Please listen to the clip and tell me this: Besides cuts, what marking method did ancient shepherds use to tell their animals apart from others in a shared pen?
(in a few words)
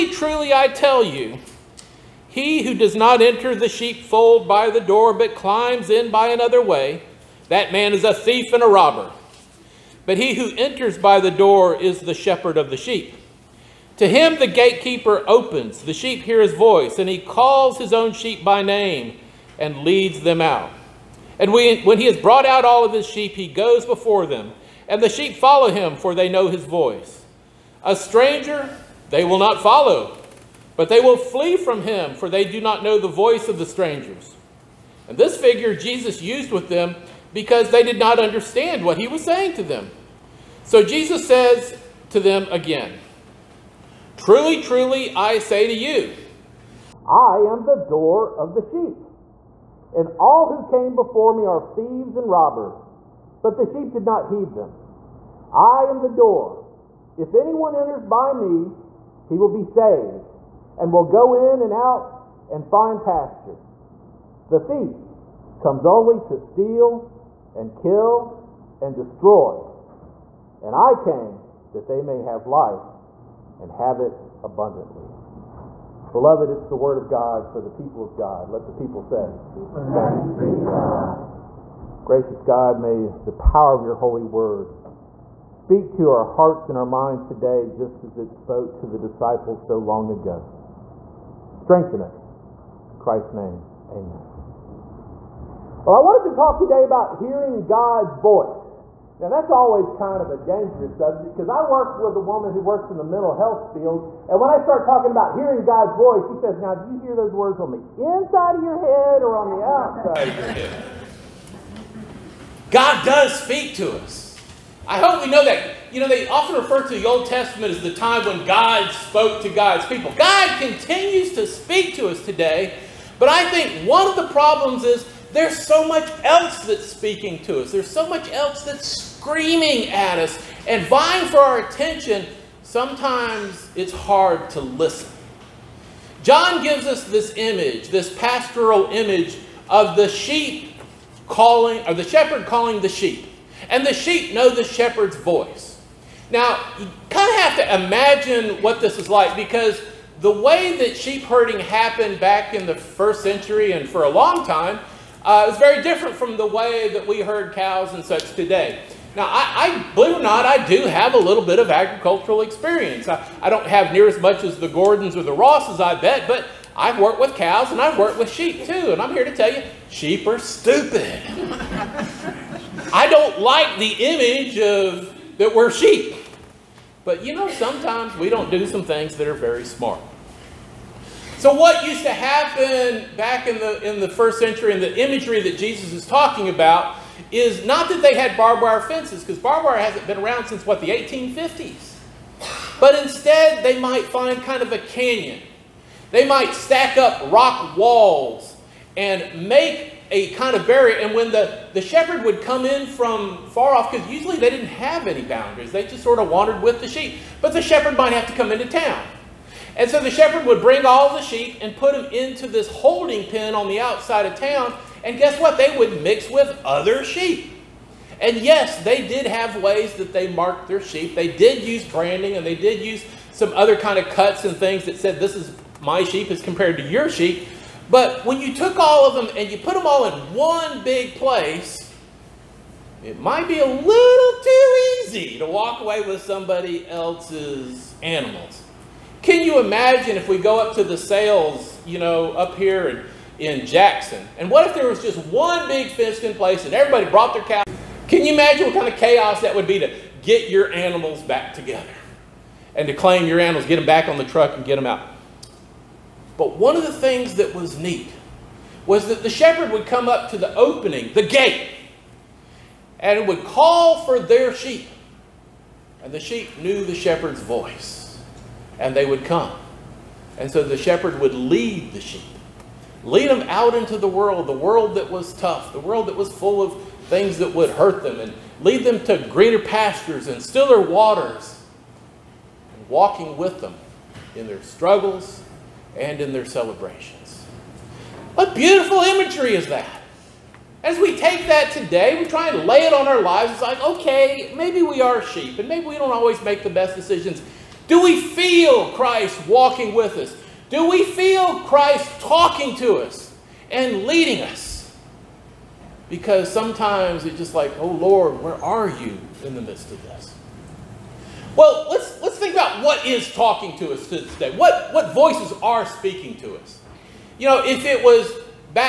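branding.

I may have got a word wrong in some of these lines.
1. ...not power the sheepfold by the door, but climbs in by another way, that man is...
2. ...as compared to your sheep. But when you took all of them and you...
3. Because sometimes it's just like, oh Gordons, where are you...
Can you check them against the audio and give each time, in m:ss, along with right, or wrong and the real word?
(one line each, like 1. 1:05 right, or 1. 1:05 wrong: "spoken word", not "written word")
1. 0:02 wrong: "enter", not "power"
2. 3:46 right
3. 5:06 wrong: "Lord", not "Gordons".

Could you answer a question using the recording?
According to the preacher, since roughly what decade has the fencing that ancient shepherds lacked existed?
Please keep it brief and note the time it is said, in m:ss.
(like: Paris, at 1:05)
1850s, at 3:10.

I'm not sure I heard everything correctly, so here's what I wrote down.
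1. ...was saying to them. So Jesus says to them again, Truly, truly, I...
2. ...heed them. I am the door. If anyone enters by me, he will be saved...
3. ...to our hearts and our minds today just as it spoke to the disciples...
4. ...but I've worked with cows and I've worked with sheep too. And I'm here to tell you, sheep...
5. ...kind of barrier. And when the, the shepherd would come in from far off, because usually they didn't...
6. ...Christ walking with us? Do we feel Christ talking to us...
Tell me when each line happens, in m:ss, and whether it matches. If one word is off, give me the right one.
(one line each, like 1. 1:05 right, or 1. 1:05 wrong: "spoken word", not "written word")
1. 0:39 right
2. 0:54 right
3. 1:25 right
4. 2:46 right
5. 3:20 right
6. 4:58 right.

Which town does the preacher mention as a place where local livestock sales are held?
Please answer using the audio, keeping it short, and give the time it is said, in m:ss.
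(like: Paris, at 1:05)
Jackson, at 4:03.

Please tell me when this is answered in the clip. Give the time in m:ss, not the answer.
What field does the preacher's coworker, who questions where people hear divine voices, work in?
1:43.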